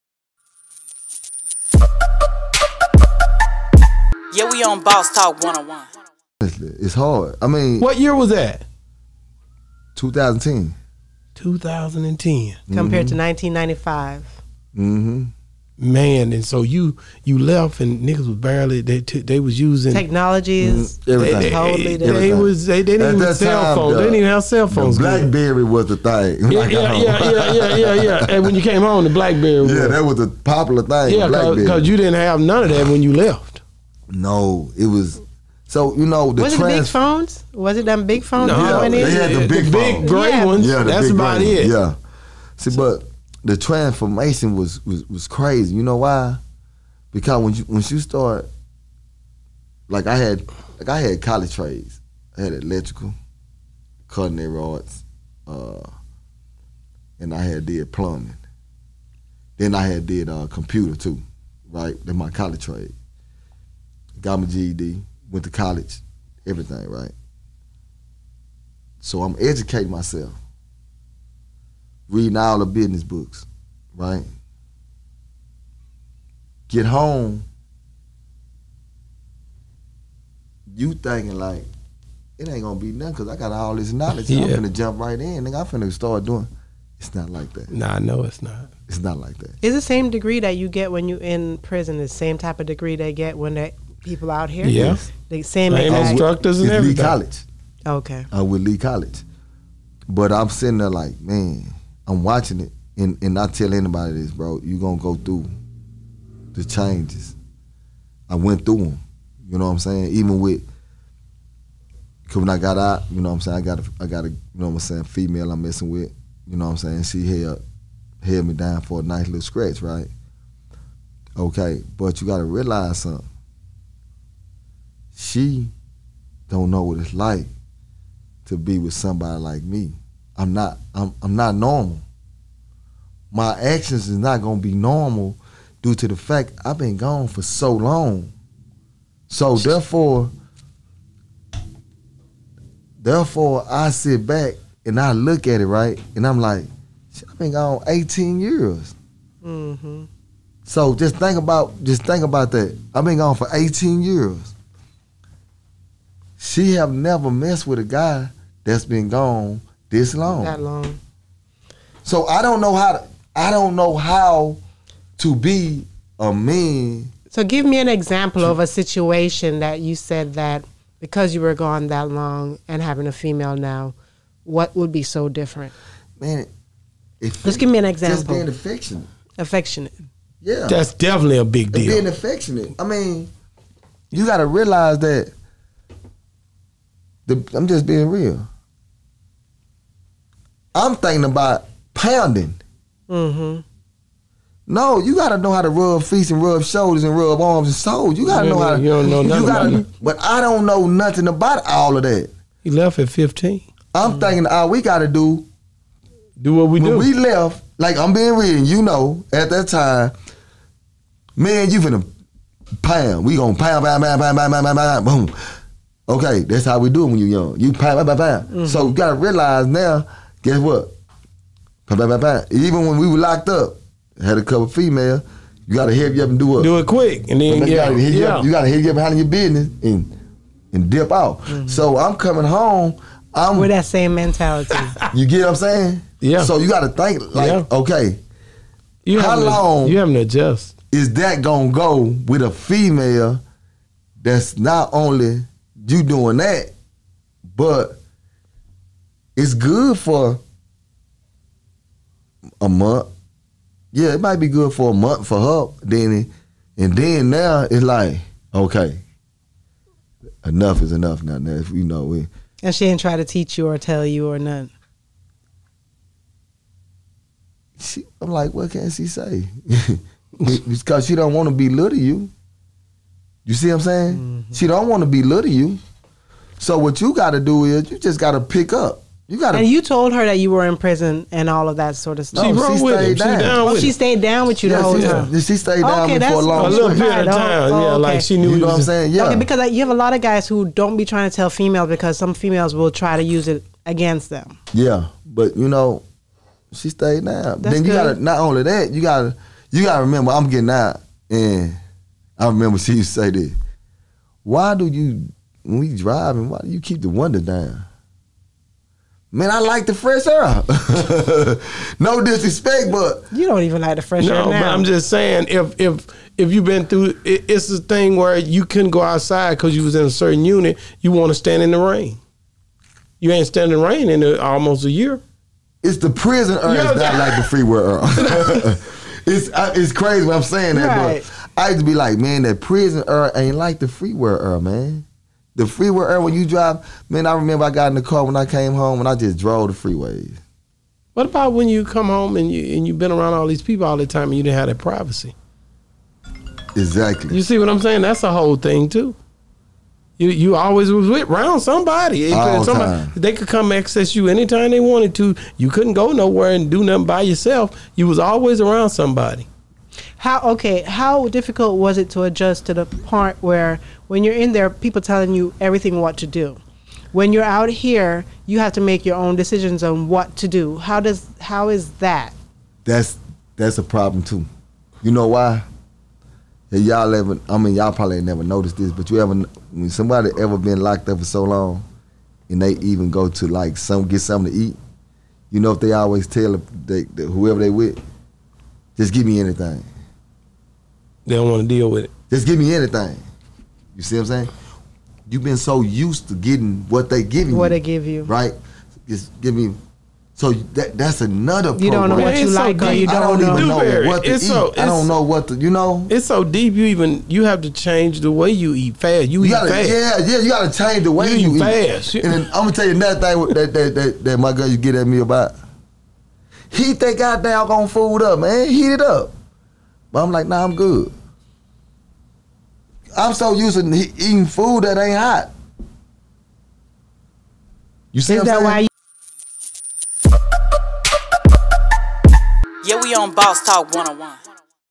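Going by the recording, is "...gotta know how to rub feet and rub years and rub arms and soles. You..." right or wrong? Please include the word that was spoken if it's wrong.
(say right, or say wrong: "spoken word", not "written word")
wrong: "shoulders", not "years".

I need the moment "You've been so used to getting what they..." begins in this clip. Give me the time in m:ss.
6:35.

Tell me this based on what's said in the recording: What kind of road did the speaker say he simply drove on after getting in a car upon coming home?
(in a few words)
The freeways.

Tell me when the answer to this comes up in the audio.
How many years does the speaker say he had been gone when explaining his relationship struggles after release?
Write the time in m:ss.
2:27.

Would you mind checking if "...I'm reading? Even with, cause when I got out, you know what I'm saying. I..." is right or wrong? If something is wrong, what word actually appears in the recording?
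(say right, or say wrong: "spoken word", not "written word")
wrong: "saying", not "reading".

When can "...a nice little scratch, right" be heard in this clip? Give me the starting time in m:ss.
1:58.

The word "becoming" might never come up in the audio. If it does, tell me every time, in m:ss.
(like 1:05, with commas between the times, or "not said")
not said.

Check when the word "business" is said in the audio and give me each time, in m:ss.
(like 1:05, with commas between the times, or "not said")
1:12, 3:49.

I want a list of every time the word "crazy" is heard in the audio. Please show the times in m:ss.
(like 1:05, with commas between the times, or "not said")
0:45, 5:29.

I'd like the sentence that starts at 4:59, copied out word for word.
You gotta remember, I'm getting out and I remember she used to say this.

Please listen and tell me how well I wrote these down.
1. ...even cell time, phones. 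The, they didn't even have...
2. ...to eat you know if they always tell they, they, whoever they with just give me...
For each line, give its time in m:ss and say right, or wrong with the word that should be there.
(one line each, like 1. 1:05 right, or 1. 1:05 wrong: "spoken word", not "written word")
1. 0:23 right
2. 6:24 right.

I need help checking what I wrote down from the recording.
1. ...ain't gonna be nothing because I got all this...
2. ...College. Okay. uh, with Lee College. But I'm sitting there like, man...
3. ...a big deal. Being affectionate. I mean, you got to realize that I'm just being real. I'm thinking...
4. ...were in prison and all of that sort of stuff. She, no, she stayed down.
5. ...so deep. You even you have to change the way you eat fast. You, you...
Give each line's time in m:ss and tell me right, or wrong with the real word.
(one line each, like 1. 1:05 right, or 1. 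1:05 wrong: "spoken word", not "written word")
1. 1:22 right
2. 1:36 right
3. 3:01 right
4. 4:40 right
5. 6:46 right.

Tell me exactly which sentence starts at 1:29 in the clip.
It's the same degree that you get when you in prison.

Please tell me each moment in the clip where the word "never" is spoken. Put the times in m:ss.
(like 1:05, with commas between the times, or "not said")
2:36, 6:18.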